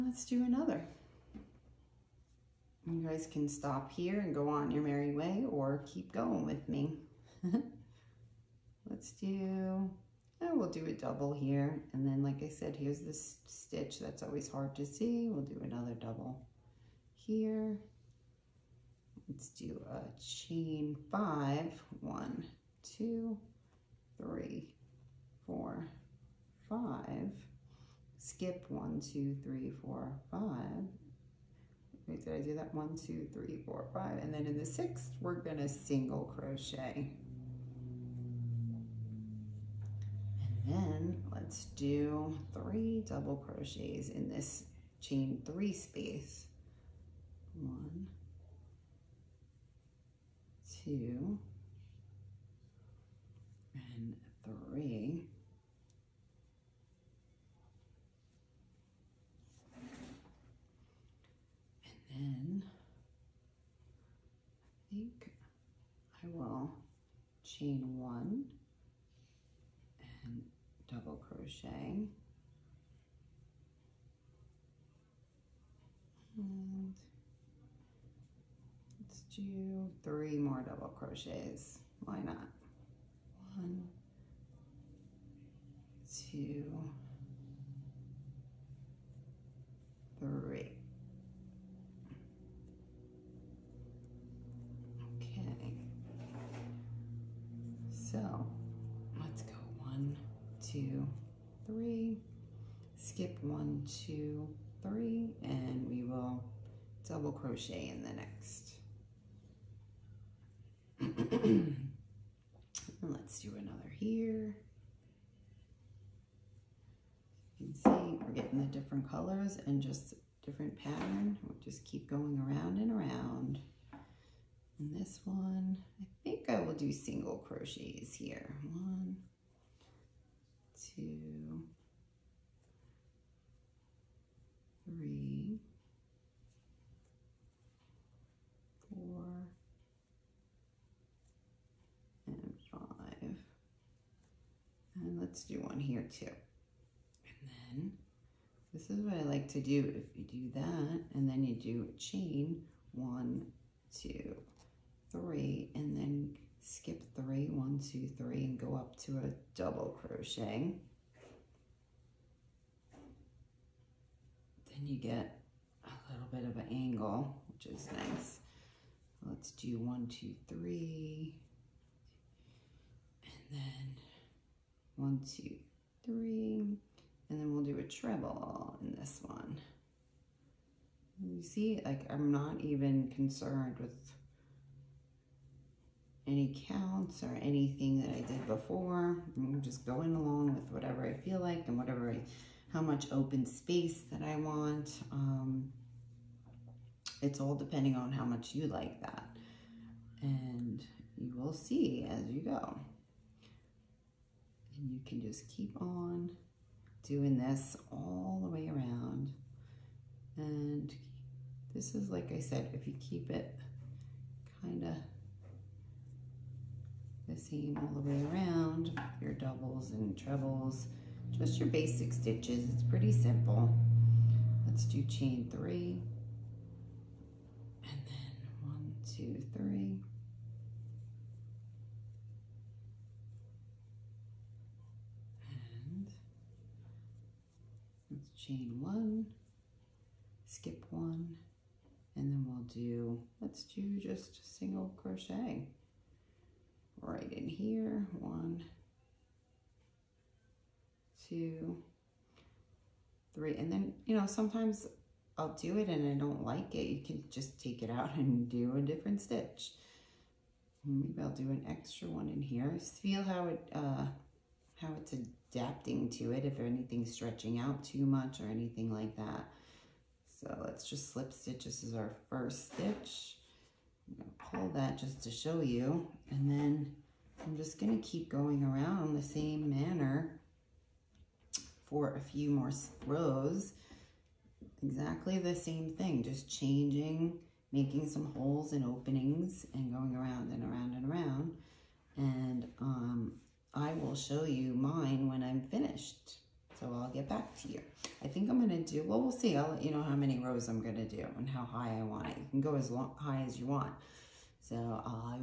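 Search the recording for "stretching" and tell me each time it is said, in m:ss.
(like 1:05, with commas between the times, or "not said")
4:27.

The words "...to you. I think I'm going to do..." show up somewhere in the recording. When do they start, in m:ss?
4:57.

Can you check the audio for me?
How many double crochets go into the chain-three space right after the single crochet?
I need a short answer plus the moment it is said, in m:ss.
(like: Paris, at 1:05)
3, at 0:42.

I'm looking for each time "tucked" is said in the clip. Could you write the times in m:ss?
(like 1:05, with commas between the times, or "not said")
not said.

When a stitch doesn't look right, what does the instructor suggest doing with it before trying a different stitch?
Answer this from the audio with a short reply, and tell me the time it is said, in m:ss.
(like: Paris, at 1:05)
take it out, at 4:17.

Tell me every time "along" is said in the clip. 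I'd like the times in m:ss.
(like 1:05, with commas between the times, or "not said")
3:10.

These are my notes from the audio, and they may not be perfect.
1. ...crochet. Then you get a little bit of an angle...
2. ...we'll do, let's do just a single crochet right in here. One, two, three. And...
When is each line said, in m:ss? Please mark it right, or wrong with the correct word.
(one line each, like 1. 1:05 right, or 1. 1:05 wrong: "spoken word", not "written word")
1. 2:40 right
2. 4:02 right.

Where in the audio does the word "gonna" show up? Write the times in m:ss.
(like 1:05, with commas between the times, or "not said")
0:35, 4:37.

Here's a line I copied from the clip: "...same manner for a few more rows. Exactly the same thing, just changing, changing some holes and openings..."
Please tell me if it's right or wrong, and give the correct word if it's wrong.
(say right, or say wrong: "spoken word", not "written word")
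wrong: "making", not "changing".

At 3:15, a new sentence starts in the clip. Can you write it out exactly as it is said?
Um, it's all depending on how much you like that.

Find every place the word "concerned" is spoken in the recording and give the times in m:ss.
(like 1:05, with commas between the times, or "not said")
3:03.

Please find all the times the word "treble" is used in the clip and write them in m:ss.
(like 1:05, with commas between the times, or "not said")
2:57, 3:40.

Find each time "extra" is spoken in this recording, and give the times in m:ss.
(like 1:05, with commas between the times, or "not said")
4:21.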